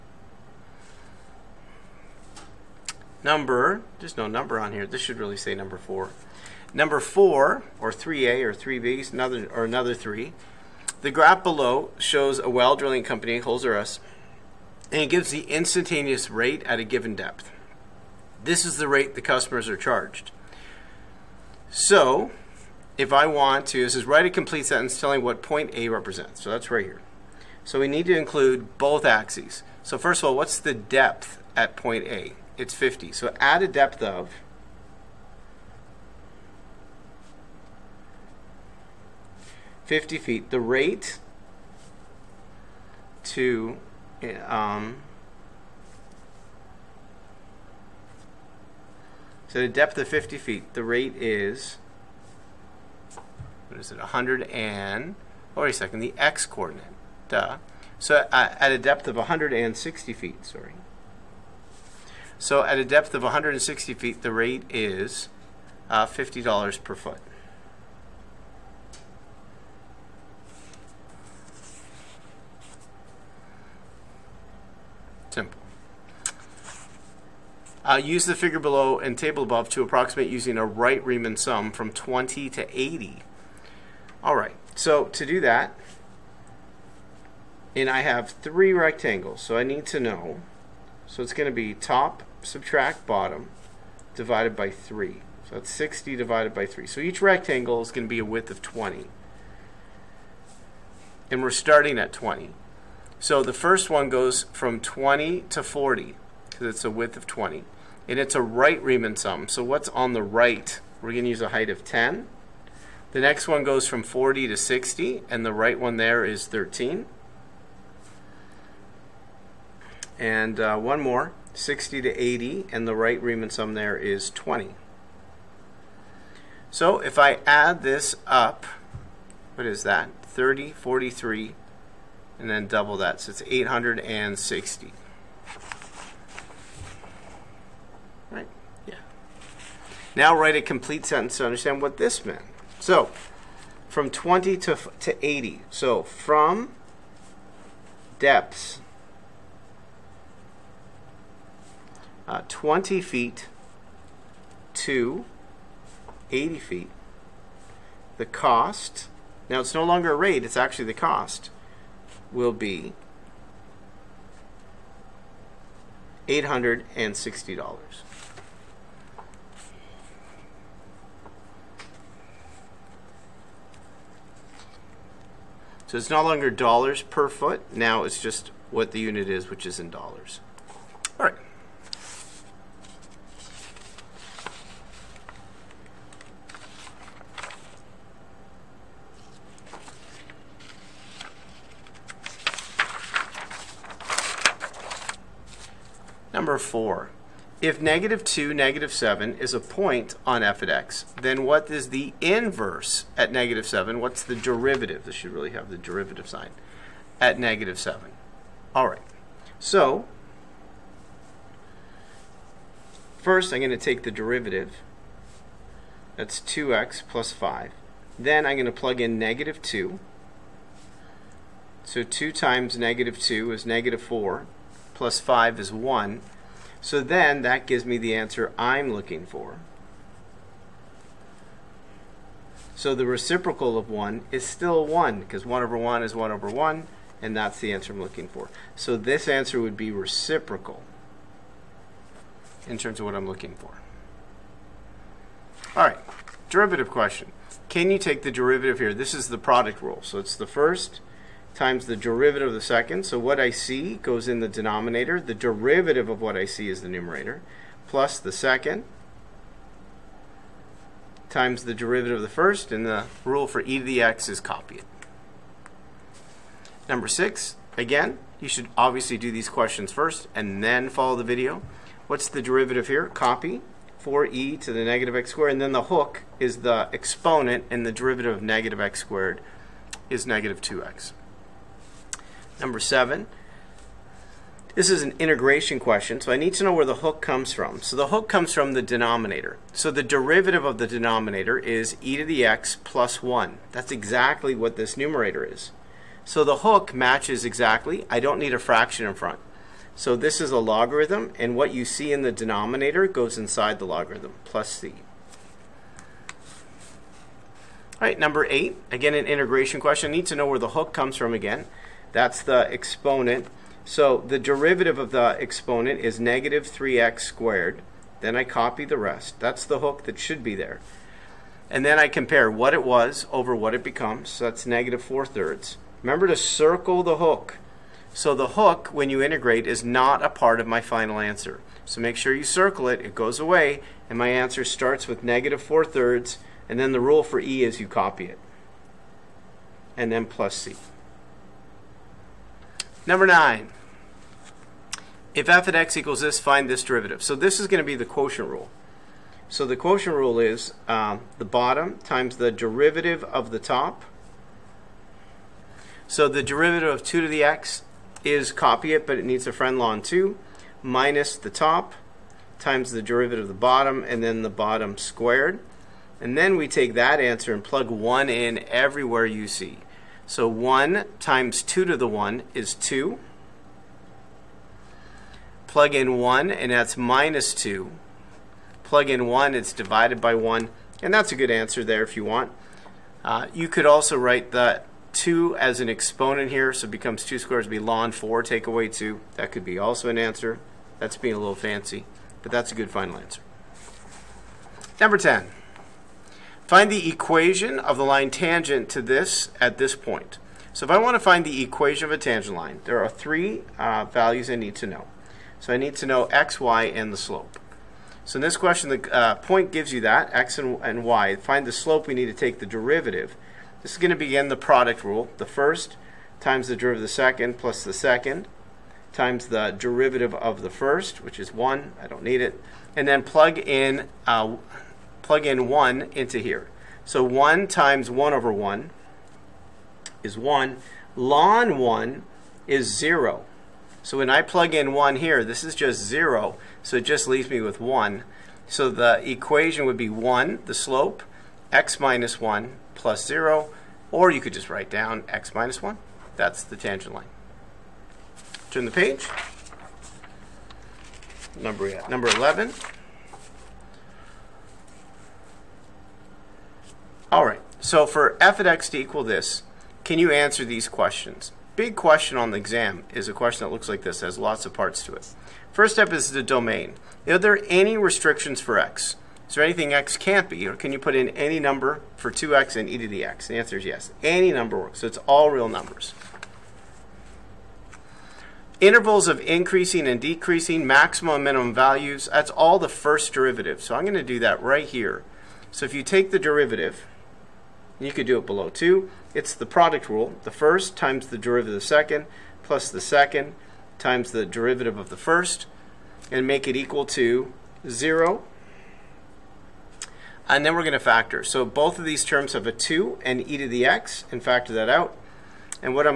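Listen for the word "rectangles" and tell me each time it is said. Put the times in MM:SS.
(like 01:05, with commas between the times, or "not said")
01:28, 01:37.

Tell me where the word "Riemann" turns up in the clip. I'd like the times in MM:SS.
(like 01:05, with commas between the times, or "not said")
01:21, 01:48, 02:03.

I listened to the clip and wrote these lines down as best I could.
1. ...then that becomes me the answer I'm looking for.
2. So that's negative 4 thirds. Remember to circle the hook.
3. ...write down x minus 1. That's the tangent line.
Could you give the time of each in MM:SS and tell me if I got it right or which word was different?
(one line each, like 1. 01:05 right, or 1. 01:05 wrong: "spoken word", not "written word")
1. 03:47 wrong: "gives", not "becomes"
2. 05:24 right
3. 07:24 right.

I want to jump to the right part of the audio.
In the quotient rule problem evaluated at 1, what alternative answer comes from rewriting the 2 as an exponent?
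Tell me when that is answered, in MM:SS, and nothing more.
06:27.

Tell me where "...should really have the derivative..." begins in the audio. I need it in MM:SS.
03:25.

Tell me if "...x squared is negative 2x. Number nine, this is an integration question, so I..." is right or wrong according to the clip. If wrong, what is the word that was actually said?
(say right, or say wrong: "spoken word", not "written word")
wrong: "seven", not "nine".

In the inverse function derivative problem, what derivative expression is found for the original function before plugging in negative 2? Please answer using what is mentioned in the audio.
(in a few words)
2x plus 5.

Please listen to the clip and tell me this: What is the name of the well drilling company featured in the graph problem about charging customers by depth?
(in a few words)
Holes R Us.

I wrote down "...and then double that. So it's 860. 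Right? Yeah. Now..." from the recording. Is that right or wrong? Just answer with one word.
right.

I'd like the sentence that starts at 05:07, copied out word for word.
All right, number eight, again an integration question.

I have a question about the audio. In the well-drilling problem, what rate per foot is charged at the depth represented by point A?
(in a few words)
$50 per foot.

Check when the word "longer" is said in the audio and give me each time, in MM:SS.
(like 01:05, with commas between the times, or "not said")
02:39, 02:56.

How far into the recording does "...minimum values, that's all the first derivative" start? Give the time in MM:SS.
08:01.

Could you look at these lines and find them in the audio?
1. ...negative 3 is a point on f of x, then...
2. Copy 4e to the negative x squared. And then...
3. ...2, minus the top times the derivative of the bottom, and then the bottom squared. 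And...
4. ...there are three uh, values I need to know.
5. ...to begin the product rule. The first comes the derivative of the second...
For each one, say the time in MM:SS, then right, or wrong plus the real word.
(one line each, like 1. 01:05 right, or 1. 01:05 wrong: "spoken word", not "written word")
1. 03:18 wrong: "7", not "3"
2. 04:33 right
3. 06:00 right
4. 06:42 right
5. 06:54 wrong: "times", not "comes".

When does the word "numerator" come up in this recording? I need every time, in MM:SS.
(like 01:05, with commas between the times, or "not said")
04:16, 04:54.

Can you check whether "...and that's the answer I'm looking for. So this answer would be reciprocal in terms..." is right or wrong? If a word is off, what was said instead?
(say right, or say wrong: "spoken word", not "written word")
right.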